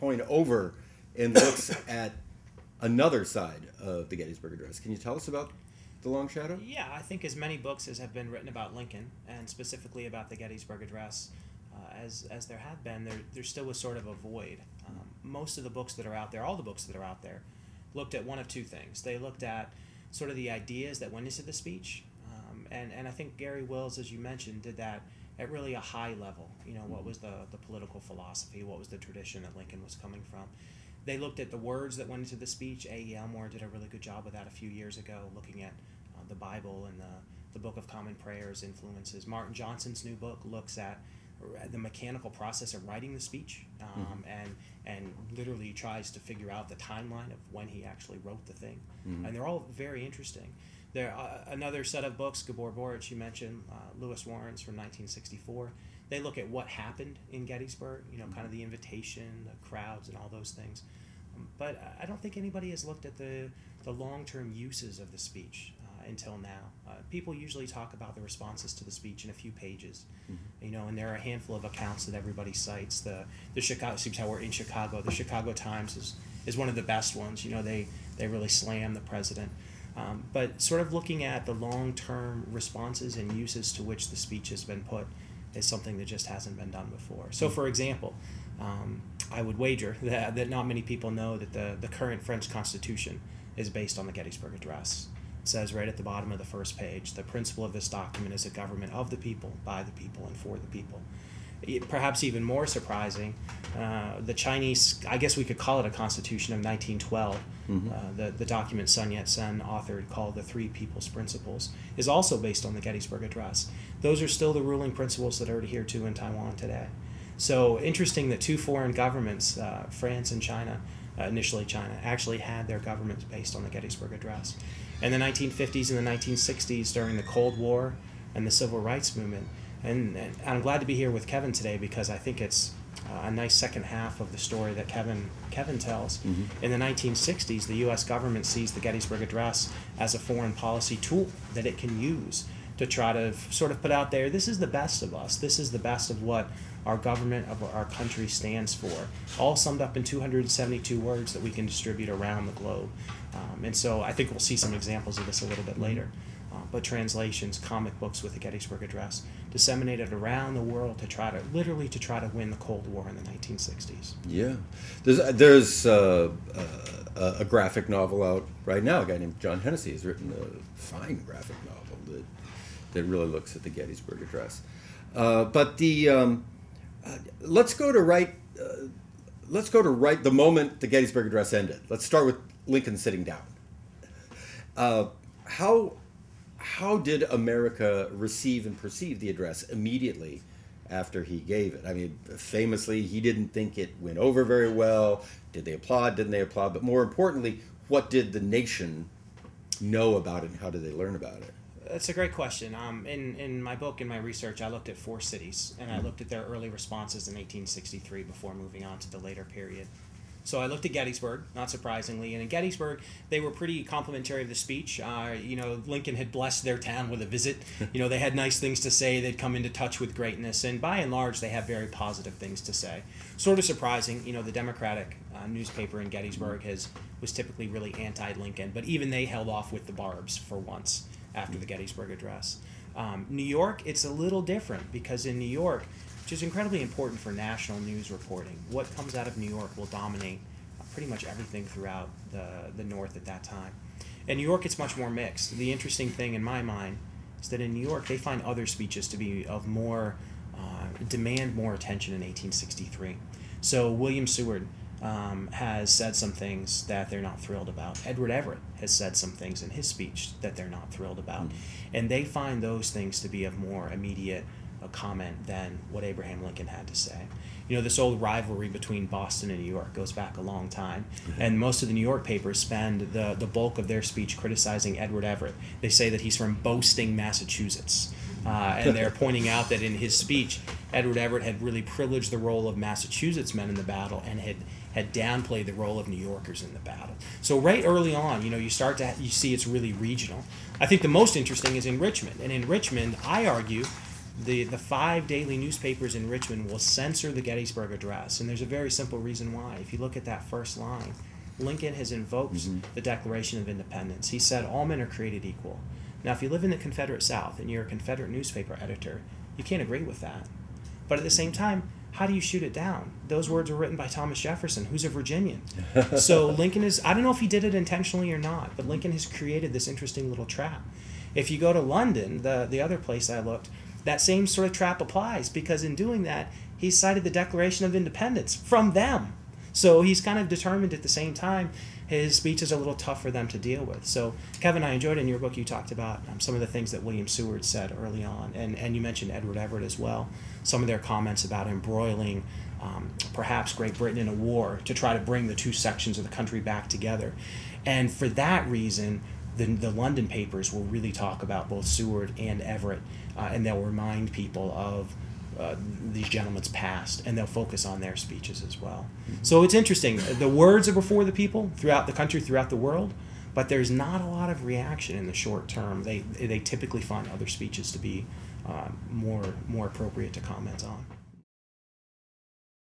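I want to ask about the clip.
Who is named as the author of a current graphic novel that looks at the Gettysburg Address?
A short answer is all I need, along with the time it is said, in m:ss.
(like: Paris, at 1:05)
John Hennessey, at 2:49.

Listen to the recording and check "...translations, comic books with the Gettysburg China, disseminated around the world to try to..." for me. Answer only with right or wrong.
wrong.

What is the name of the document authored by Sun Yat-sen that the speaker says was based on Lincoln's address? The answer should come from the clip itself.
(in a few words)
Three People's Principles.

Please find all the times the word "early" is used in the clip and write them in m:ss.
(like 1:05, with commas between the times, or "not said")
3:26, 4:47, 5:37.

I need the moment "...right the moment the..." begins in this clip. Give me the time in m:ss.
2:59.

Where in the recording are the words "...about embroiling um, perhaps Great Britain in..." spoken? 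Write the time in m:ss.
5:41.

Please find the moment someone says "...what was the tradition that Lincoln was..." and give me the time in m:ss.
0:28.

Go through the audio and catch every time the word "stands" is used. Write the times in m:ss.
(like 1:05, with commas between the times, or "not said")
2:28.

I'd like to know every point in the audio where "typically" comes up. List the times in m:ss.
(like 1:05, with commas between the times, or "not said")
3:47, 6:06.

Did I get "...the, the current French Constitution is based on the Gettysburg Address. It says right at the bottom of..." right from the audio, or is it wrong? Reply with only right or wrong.
right.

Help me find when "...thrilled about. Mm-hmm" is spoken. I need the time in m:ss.
4:20.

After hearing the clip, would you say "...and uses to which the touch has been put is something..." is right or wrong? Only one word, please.
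wrong.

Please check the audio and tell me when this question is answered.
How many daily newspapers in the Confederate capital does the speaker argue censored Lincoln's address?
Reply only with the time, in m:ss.
4:54.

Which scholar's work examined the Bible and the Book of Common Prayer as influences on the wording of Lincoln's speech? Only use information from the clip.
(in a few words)
A.E. Elmore.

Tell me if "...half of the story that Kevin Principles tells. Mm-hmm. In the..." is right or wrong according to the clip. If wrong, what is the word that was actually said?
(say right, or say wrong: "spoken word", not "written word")
wrong: "Kevin", not "Principles".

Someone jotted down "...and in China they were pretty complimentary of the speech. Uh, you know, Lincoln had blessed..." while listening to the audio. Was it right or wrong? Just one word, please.
wrong.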